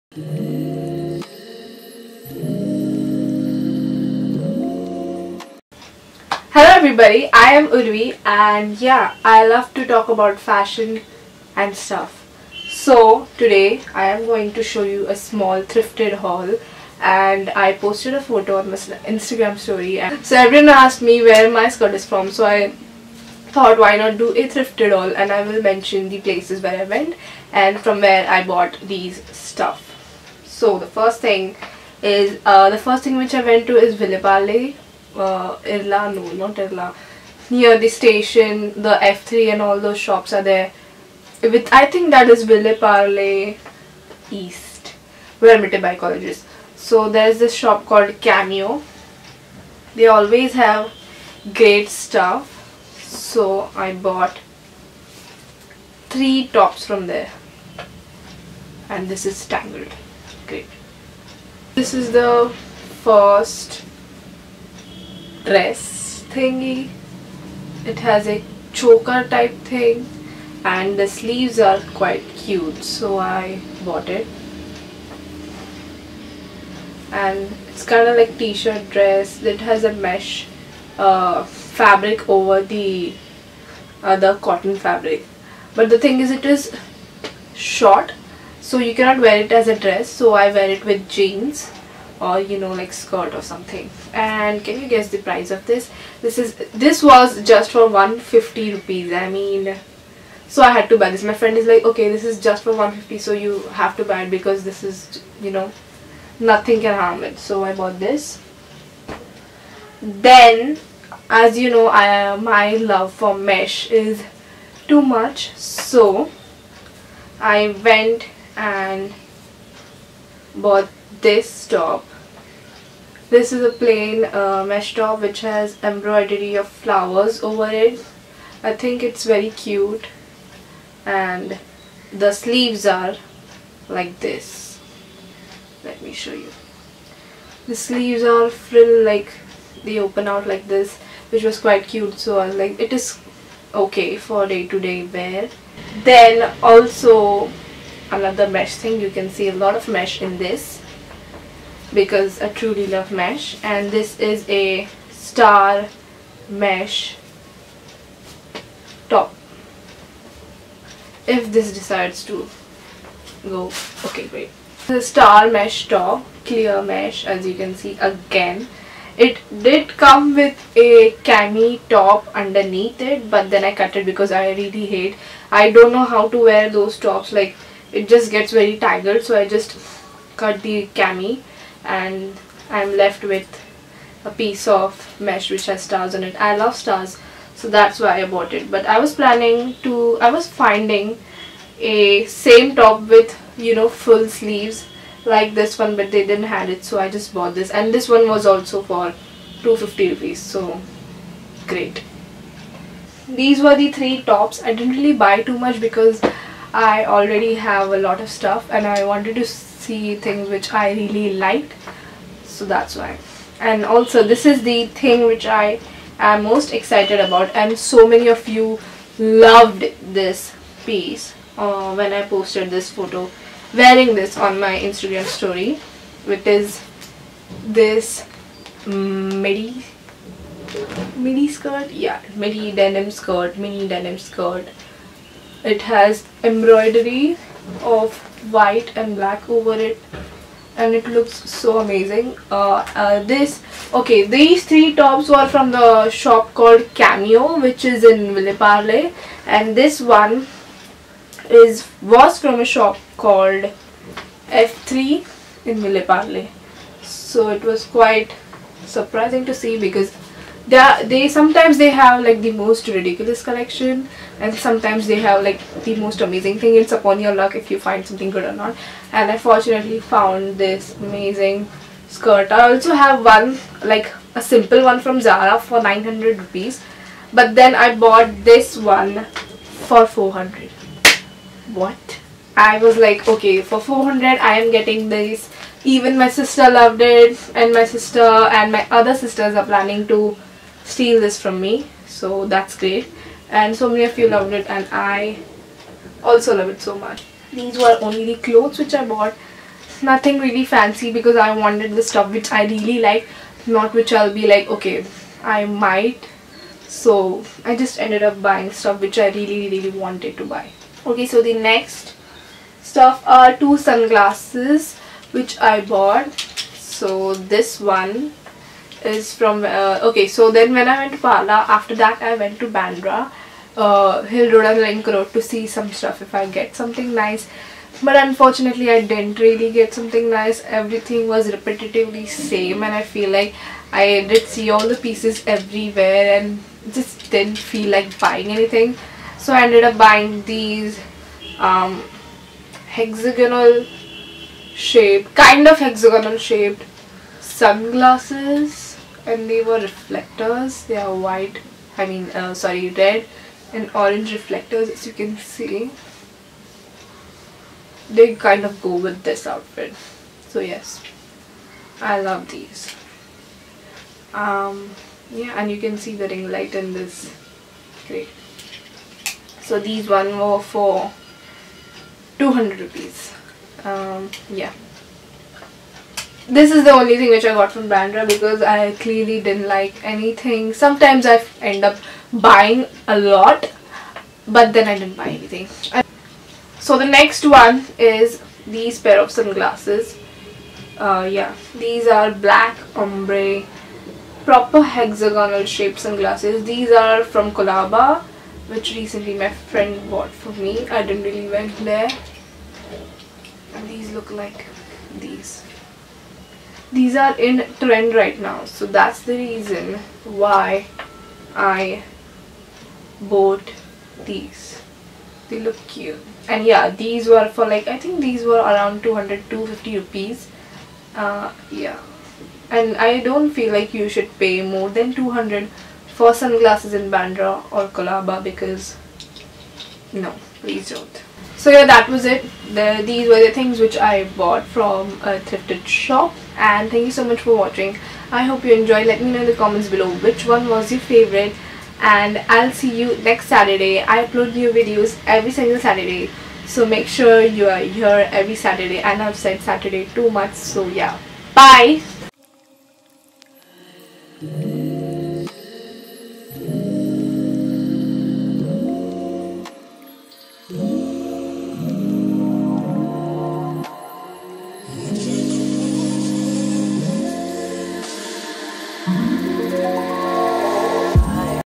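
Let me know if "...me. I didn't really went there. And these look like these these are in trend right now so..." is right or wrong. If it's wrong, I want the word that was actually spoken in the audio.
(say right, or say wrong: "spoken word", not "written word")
right.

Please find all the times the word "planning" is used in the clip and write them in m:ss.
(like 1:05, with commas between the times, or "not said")
3:09, 4:49.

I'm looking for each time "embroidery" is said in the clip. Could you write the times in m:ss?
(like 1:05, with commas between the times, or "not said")
2:05, 3:56.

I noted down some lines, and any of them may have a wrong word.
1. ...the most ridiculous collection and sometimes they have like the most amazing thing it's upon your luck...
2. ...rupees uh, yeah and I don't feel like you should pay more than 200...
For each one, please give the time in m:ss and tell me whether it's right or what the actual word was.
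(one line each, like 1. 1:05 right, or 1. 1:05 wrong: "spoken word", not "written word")
1. 4:22 right
2. 6:59 right.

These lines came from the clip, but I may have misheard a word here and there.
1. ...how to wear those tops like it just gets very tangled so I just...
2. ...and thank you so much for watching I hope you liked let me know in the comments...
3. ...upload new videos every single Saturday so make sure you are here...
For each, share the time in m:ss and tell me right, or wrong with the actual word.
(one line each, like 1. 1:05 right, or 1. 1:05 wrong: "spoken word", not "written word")
1. 2:56 right
2. 7:16 wrong: "enjoyed", not "liked"
3. 7:24 right.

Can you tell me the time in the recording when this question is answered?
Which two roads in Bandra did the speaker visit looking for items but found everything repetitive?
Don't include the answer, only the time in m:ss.
5:24.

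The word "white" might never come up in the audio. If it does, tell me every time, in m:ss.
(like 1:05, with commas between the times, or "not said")
3:58, 5:51.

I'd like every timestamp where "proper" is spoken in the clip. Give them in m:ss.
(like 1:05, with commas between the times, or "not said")
6:34.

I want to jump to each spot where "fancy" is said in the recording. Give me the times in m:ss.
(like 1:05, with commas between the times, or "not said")
5:00.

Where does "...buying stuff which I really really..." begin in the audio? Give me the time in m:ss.
5:08.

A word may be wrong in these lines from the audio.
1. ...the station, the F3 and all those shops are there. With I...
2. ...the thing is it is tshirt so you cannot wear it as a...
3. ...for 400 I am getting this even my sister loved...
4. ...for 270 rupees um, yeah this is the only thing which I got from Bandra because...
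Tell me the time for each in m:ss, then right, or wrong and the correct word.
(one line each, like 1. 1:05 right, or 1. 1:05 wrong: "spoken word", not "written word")
1. 0:37 right
2. 1:25 wrong: "short", not "tshirt"
3. 4:43 right
4. 6:10 wrong: "200", not "270".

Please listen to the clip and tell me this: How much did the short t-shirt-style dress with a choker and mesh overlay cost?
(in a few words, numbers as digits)
150 rupees.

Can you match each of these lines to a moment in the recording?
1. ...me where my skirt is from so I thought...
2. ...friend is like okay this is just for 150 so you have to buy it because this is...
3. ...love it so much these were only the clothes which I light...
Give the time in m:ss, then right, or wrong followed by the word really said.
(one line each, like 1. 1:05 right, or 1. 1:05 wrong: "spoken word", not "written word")
1. 0:21 right
2. 1:41 right
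3. 4:56 wrong: "bought", not "light".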